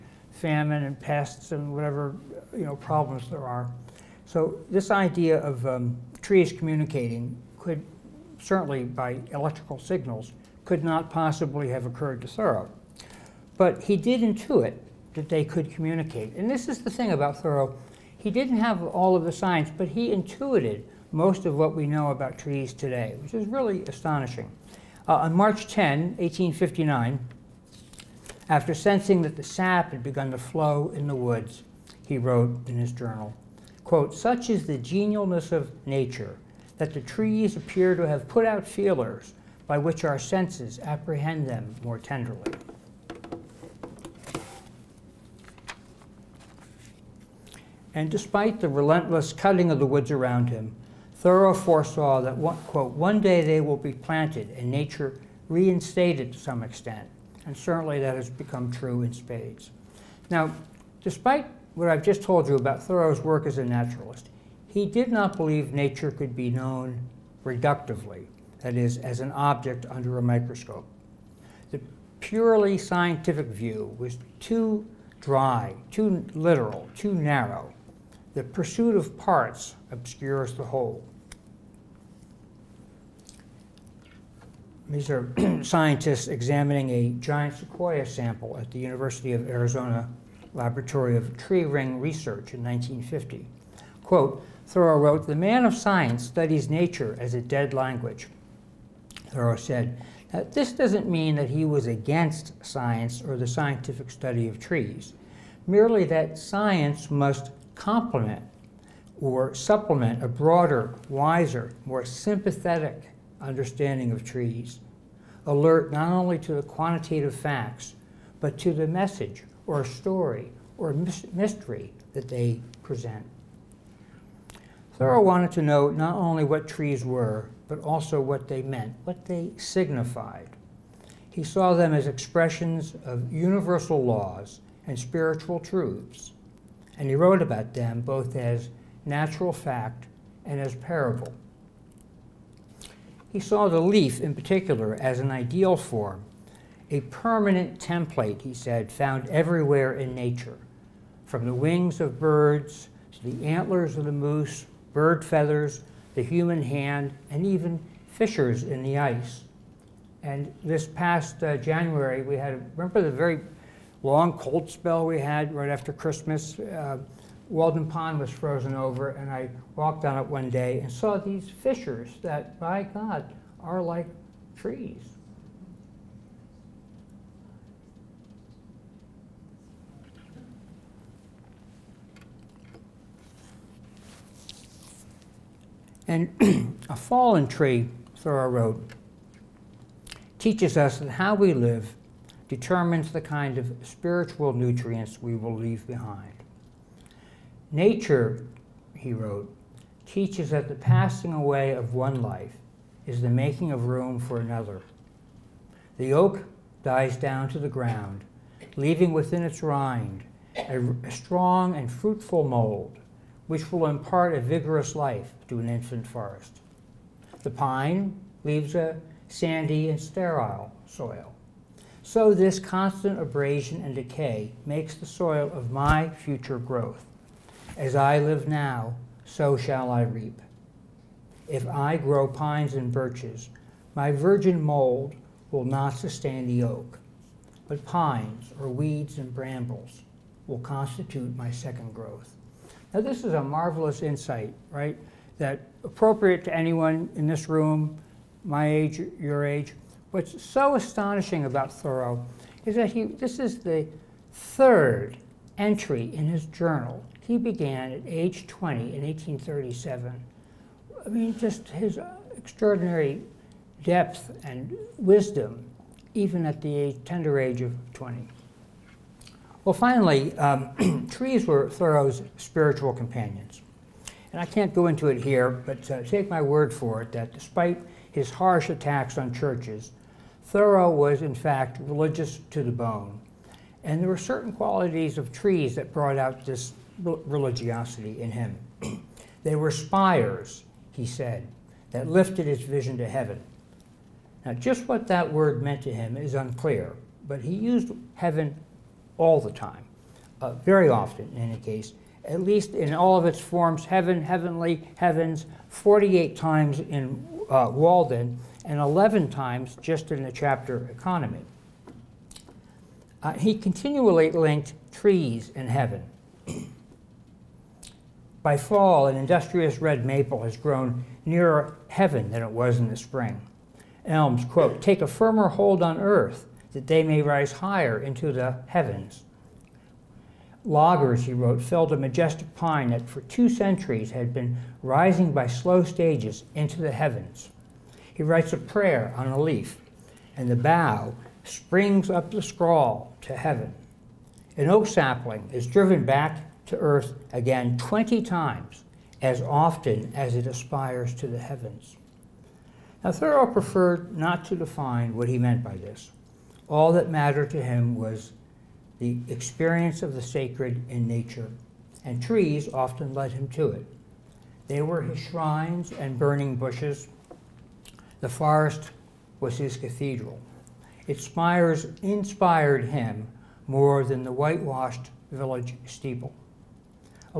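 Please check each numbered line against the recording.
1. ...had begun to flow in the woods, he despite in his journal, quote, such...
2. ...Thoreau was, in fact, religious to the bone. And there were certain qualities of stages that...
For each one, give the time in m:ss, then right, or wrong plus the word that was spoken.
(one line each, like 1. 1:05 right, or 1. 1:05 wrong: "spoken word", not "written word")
1. 0:29 wrong: "wrote", not "despite"
2. 4:40 wrong: "trees", not "stages".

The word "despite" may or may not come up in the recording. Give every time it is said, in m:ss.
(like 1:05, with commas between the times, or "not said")
0:48, 1:00, 4:37.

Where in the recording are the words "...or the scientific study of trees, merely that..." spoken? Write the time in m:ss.
1:43.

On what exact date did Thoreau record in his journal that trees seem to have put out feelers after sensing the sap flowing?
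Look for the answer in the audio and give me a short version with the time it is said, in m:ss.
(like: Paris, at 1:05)
March 10, 1859, at 0:25.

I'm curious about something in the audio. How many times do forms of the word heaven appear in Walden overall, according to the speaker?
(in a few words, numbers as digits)
48.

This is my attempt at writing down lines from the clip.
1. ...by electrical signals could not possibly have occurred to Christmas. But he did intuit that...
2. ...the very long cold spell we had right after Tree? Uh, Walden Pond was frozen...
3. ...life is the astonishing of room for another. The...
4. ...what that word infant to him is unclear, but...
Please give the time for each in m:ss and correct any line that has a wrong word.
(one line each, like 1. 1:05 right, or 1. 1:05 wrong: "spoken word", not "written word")
1. 0:08 wrong: "Thoreau", not "Christmas"
2. 2:43 wrong: "Christmas", not "Tree"
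3. 3:22 wrong: "making", not "astonishing"
4. 4:54 wrong: "meant", not "infant".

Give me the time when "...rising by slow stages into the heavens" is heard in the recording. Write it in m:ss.
5:34.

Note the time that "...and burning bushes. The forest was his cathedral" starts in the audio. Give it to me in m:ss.
6:05.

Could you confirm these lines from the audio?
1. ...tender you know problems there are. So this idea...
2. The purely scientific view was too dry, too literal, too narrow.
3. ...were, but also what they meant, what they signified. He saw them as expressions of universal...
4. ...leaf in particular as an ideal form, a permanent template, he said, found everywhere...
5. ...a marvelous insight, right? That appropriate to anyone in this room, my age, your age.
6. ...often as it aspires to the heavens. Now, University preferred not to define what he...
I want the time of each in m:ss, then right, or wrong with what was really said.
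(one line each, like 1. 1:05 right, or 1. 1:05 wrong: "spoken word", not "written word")
1. 0:01 wrong: "whatever", not "tender"
2. 1:11 right
3. 2:07 right
4. 2:23 right
5. 4:03 right
6. 5:49 wrong: "Thoreau", not "University".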